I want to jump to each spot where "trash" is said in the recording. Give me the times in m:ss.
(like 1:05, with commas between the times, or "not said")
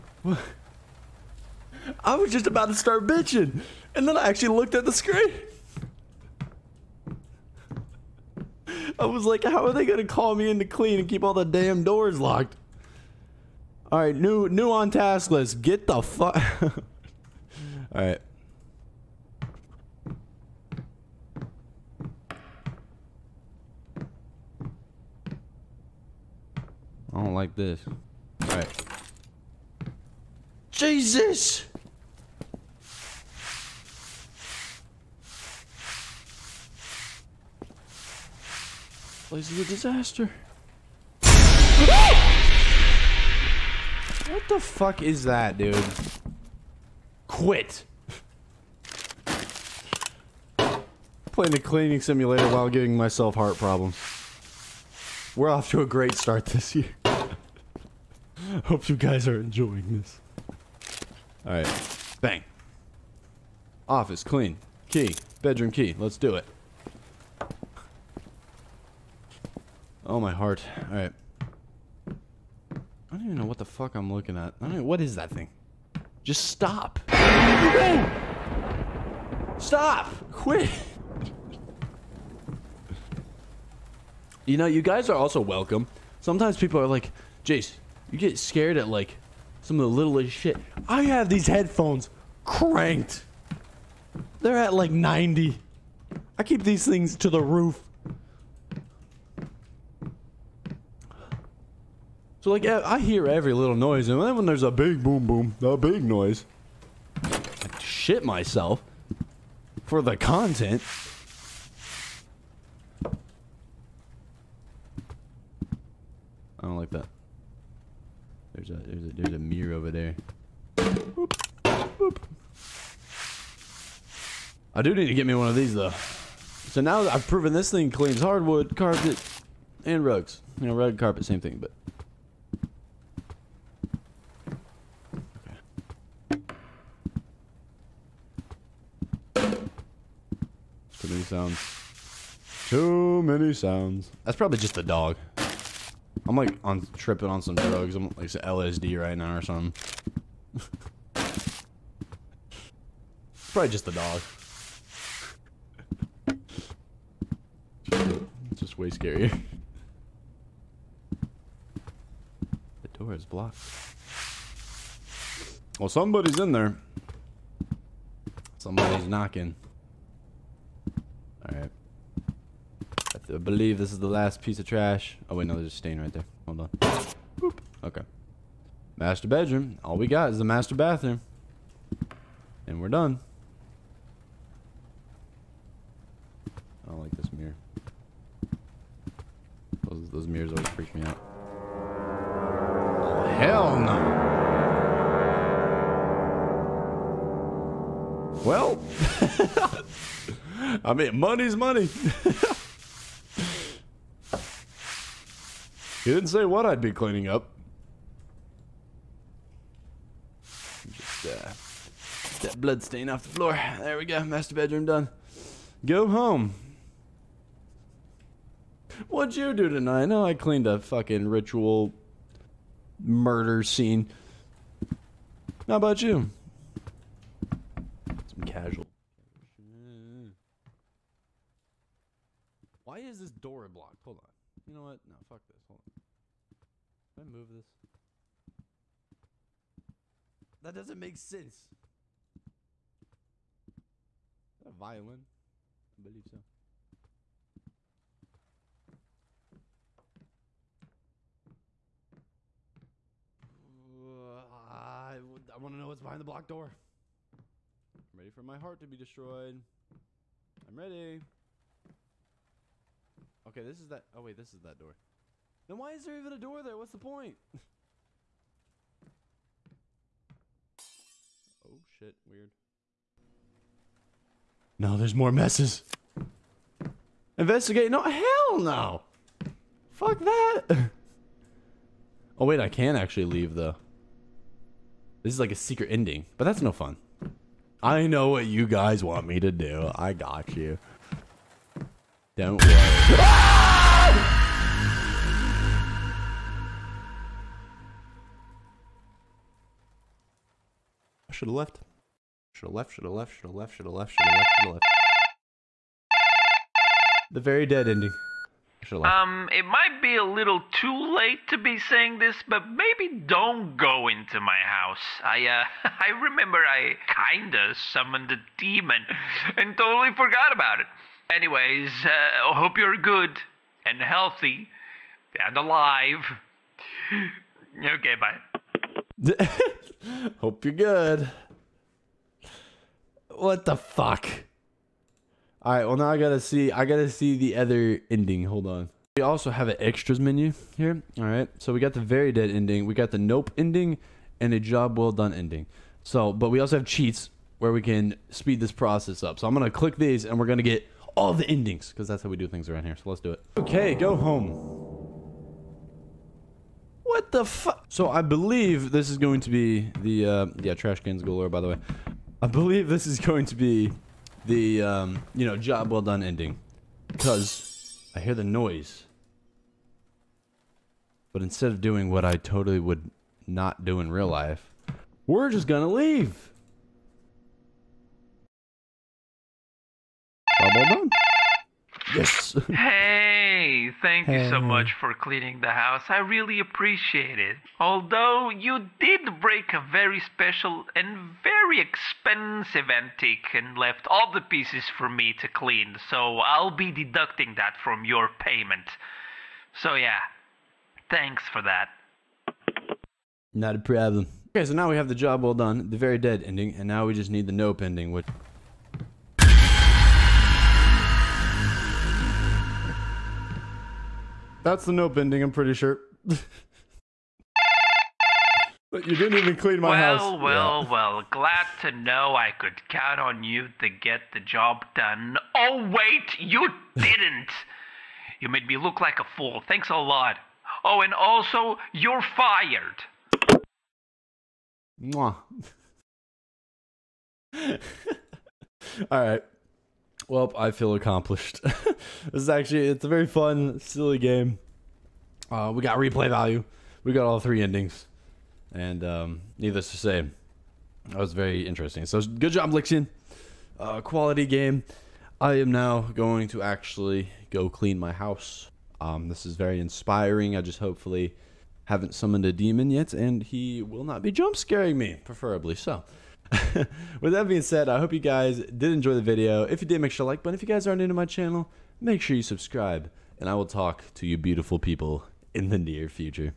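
2:54, 6:00.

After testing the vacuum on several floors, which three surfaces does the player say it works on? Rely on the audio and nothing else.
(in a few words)
hardwood, carpet, and rugs.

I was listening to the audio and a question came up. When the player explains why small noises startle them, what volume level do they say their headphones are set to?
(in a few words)
90.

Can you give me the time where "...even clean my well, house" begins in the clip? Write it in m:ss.
6:59.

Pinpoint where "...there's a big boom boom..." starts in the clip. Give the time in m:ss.
1:44.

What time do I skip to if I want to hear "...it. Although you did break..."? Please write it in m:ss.
6:27.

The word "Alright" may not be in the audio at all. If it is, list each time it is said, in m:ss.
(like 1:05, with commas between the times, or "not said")
1:01, 2:51.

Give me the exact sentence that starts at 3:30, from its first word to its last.
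Just uh, that blood stain off the floor.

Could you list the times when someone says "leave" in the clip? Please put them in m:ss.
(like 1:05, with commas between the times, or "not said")
4:43, 6:15.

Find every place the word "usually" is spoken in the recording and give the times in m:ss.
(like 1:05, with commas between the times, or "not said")
not said.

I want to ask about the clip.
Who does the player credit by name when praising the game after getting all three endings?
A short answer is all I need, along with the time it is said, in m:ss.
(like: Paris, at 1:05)
Lixian, at 7:32.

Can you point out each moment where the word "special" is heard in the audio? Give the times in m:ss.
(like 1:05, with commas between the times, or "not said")
6:30.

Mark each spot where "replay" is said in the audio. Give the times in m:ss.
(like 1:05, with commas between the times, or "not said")
7:25.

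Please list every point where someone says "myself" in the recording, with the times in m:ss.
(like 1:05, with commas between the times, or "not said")
0:52, 1:48.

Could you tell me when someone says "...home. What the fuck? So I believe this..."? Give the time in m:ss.
5:54.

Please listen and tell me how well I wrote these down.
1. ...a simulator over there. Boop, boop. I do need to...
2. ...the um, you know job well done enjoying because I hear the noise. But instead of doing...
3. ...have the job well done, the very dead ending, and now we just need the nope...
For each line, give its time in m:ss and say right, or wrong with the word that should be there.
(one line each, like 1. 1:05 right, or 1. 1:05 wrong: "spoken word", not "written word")
1. 1:59 wrong: "mirror", not "simulator"
2. 6:04 wrong: "ending", not "enjoying"
3. 6:44 right.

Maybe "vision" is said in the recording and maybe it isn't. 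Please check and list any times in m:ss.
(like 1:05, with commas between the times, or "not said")
not said.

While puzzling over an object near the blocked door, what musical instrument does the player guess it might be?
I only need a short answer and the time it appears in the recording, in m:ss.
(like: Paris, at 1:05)
violin, at 4:02.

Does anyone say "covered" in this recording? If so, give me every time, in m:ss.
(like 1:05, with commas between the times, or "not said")
not said.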